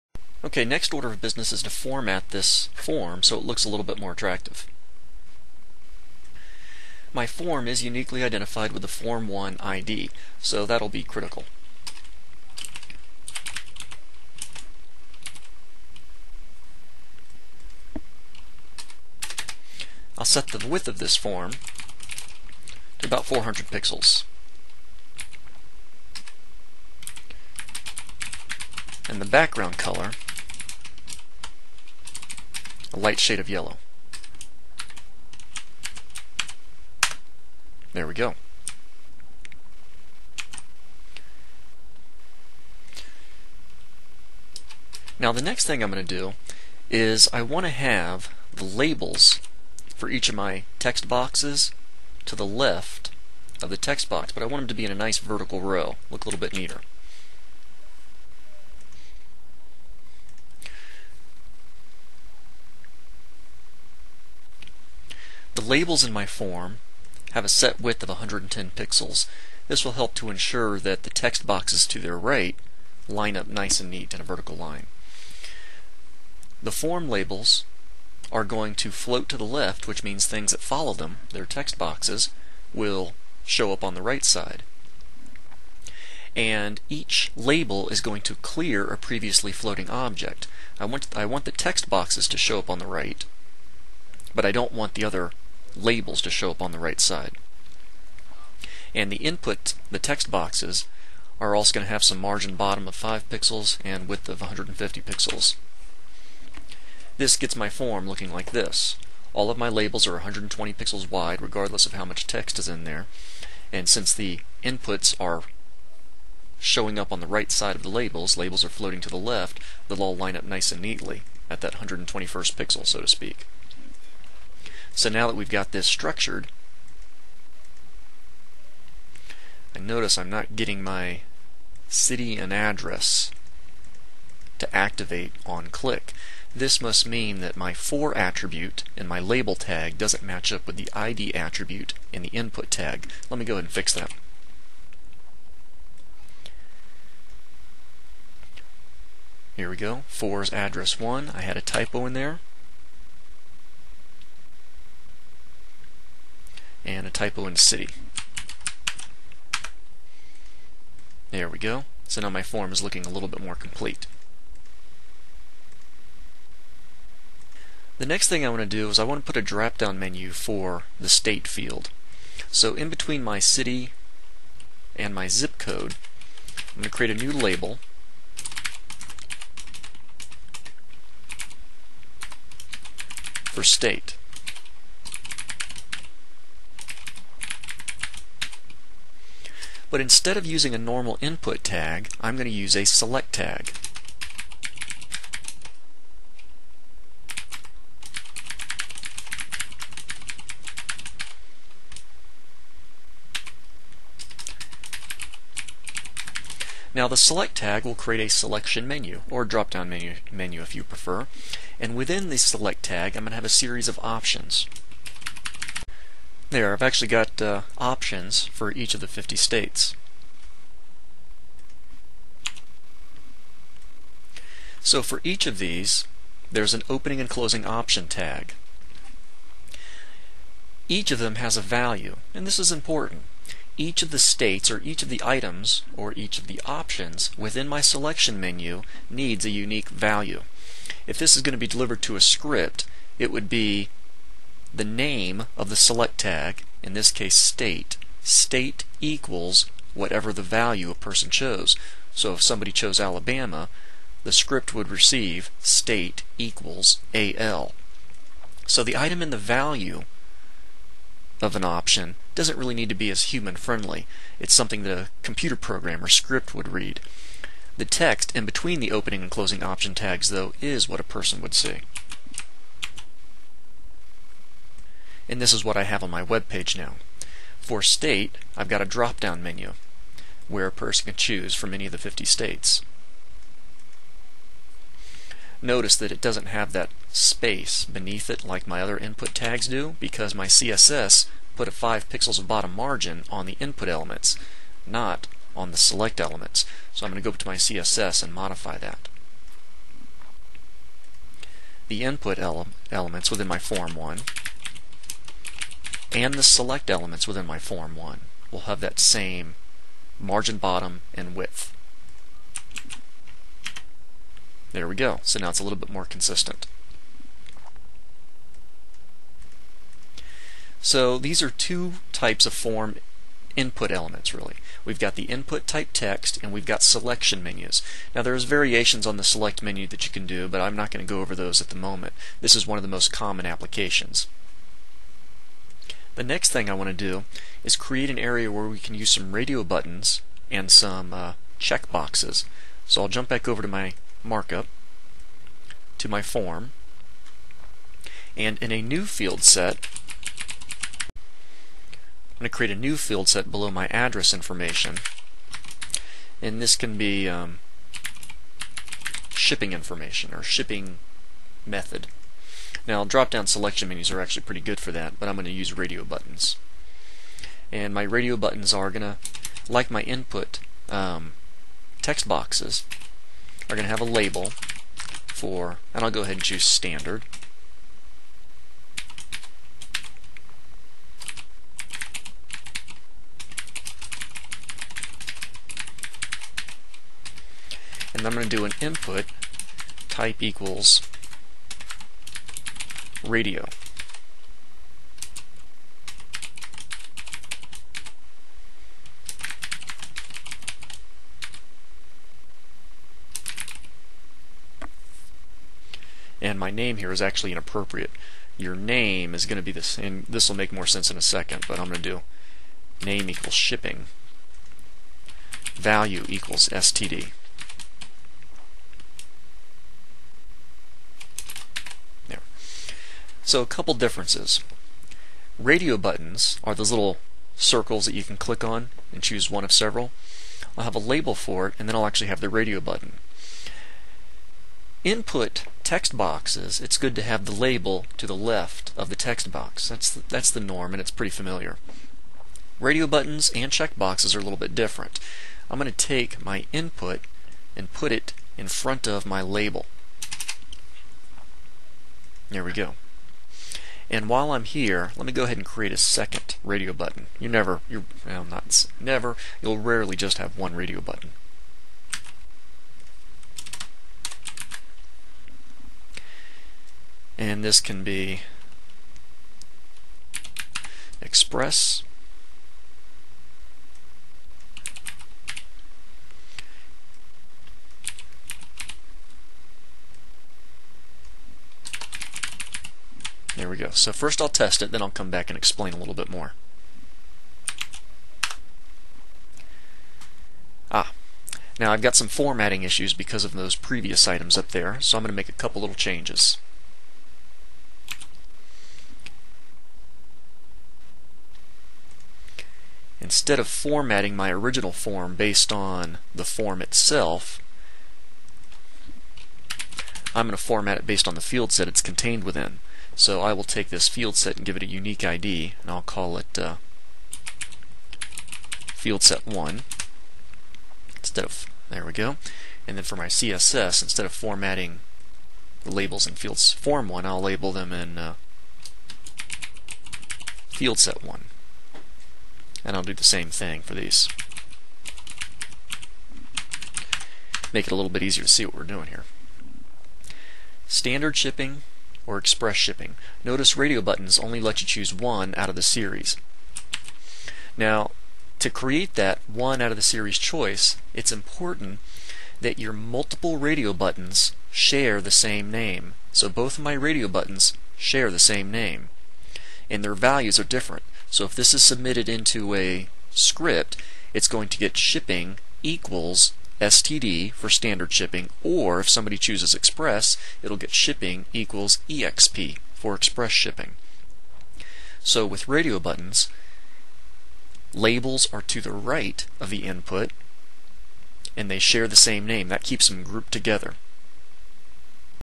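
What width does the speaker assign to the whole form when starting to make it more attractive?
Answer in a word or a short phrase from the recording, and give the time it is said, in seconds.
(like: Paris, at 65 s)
400 pixels, at 23 s.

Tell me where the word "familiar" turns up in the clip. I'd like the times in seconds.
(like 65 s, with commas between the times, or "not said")
441 s.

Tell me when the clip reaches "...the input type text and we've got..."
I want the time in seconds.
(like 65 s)
325 s.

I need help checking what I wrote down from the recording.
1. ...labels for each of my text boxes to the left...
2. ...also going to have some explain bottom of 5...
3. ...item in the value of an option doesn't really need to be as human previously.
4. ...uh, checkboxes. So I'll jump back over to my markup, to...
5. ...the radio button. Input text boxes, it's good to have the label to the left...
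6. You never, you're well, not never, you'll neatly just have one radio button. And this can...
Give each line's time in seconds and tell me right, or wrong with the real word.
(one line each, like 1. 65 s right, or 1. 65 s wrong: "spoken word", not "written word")
1. 48 s right
2. 101 s wrong: "margin", not "explain"
3. 258 s wrong: "friendly", not "previously"
4. 341 s right
5. 432 s right
6. 457 s wrong: "rarely", not "neatly".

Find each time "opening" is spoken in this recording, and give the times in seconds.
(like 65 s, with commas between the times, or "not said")
226 s, 268 s.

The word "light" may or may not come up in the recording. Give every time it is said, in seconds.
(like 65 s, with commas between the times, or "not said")
32 s.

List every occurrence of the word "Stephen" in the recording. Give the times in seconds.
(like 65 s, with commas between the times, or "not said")
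not said.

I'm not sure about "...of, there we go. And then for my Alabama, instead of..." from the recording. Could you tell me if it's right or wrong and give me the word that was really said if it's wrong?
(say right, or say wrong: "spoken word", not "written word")
wrong: "CSS", not "Alabama".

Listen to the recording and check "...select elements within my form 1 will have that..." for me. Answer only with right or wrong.
right.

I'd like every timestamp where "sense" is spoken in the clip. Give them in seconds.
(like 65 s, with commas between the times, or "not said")
410 s.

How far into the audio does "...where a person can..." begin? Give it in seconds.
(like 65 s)
280 s.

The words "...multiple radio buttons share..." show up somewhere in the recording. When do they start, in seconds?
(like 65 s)
552 s.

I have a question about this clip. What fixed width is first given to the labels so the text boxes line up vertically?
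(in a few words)
110 pixels.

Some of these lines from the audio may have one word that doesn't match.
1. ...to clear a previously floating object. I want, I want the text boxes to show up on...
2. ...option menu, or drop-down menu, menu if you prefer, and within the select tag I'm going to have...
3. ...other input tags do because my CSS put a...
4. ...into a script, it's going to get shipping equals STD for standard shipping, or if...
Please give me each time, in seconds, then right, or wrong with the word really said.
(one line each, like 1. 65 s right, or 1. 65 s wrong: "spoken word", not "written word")
1. 88 s right
2. 208 s wrong: "selection", not "option"
3. 288 s right
4. 562 s right.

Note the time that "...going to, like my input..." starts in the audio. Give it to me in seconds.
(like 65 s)
368 s.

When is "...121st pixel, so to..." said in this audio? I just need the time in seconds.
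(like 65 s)
121 s.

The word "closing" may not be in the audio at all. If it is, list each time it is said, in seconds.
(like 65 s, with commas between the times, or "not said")
227 s, 269 s.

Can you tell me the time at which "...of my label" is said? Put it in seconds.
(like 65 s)
449 s.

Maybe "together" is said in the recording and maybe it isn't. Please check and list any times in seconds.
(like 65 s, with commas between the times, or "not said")
583 s.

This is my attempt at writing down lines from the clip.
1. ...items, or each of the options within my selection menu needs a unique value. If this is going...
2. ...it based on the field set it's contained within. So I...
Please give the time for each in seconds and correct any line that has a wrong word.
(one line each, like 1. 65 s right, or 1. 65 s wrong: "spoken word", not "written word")
1. 235 s right
2. 510 s right.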